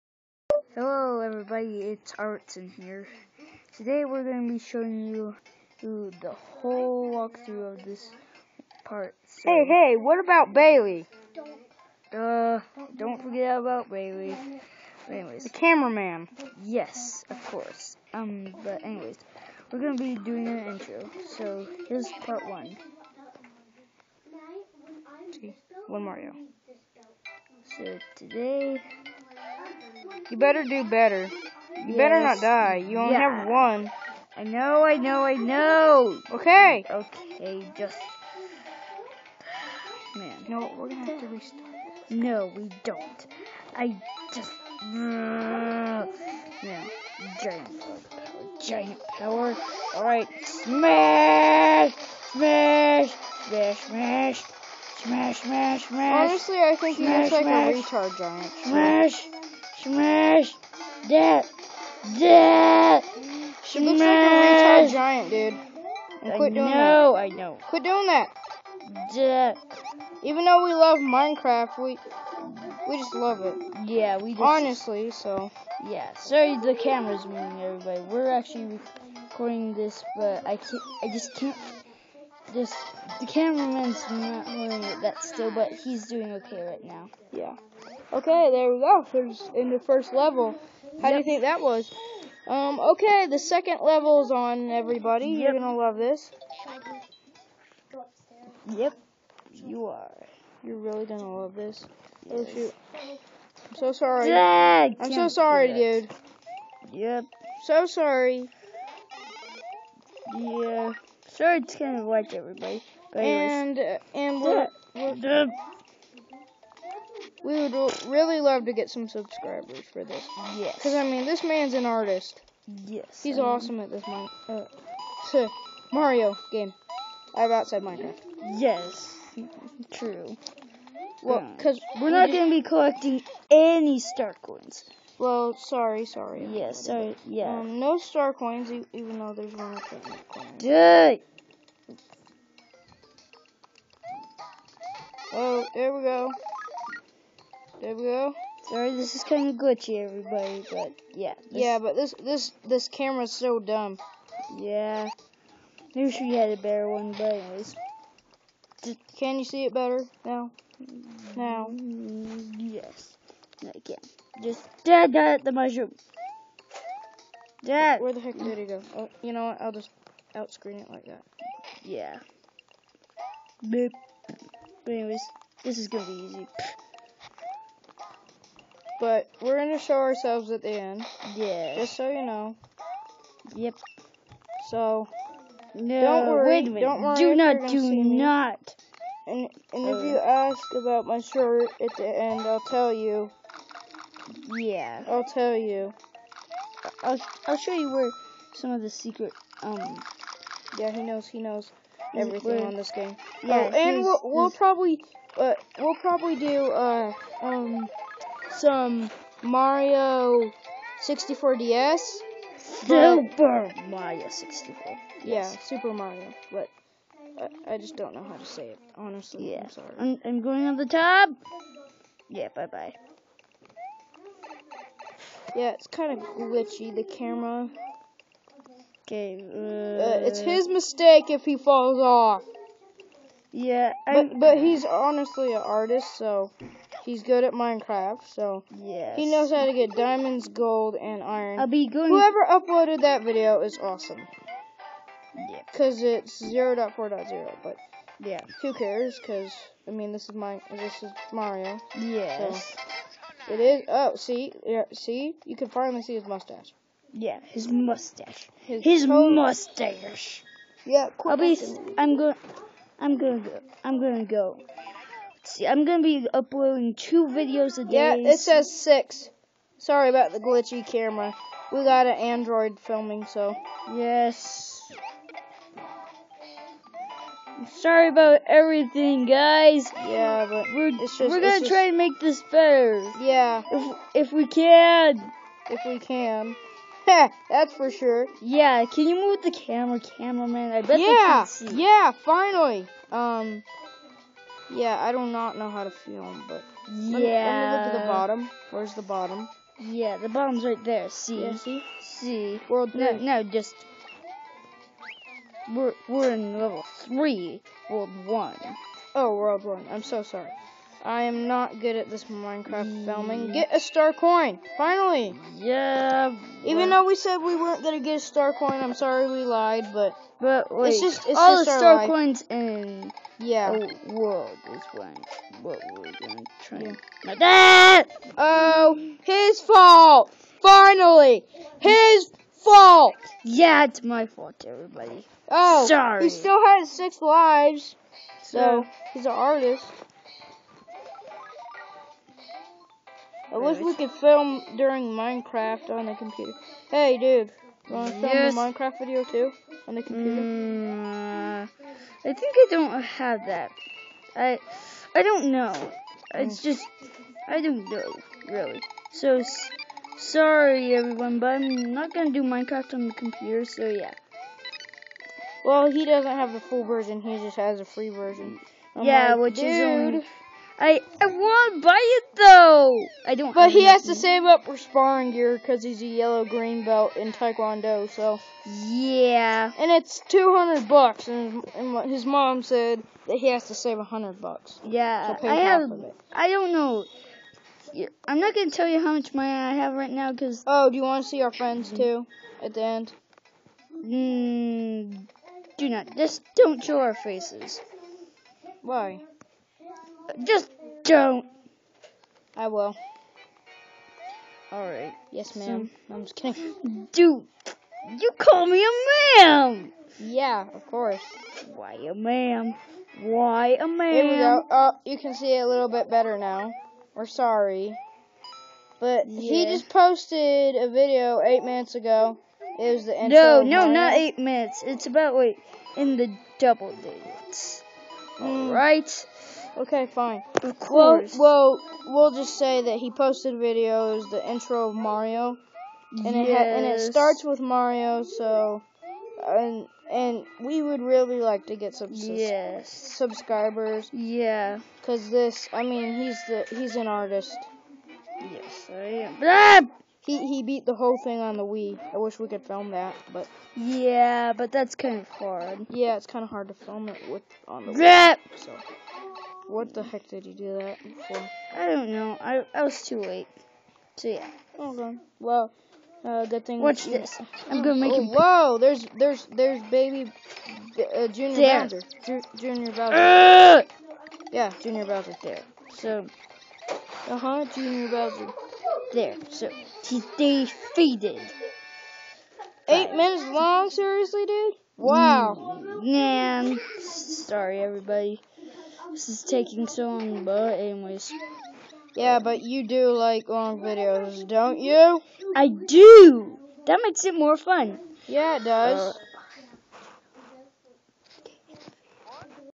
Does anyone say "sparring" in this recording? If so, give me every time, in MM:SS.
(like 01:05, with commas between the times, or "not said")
06:14.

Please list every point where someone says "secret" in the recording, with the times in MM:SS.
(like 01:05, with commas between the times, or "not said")
03:18.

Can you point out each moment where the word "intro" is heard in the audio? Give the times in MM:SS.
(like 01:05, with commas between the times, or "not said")
00:20, 07:03, 07:14.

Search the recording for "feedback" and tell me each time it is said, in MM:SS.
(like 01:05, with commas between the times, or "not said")
not said.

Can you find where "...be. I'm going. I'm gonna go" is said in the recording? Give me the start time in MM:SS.
04:21.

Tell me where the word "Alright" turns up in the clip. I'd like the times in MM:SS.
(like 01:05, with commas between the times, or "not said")
00:49, 06:44, 07:08.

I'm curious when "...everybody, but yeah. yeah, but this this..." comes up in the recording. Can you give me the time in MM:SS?
02:30.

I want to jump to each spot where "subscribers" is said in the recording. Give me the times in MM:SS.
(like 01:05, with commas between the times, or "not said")
01:59, 07:22.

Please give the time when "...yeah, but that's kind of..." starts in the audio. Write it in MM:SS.
07:33.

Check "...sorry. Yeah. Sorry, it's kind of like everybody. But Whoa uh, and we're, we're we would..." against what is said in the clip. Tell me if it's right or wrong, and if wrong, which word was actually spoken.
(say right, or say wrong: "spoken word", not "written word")
wrong: "And", not "Whoa".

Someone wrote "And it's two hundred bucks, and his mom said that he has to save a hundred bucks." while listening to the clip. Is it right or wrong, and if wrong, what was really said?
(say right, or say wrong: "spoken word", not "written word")
right.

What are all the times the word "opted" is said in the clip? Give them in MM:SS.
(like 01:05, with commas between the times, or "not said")
not said.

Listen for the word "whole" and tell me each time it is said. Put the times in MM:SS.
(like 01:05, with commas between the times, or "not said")
00:06, 07:30.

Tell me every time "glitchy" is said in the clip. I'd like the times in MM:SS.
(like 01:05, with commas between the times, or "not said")
02:29, 03:46, 04:30.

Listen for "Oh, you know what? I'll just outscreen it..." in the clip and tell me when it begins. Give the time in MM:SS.
02:48.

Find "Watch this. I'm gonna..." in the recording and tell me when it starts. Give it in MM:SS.
07:46.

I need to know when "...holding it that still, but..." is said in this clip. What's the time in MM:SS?
01:24.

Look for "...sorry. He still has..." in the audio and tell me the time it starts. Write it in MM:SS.
05:35.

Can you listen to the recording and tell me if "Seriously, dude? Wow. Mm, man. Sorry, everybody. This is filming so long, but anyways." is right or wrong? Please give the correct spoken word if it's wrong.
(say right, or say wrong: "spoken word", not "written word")
wrong: "taking", not "filming".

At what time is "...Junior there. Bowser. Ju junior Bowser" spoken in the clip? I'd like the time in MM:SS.
07:51.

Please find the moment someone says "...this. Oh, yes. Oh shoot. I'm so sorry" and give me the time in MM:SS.
01:41.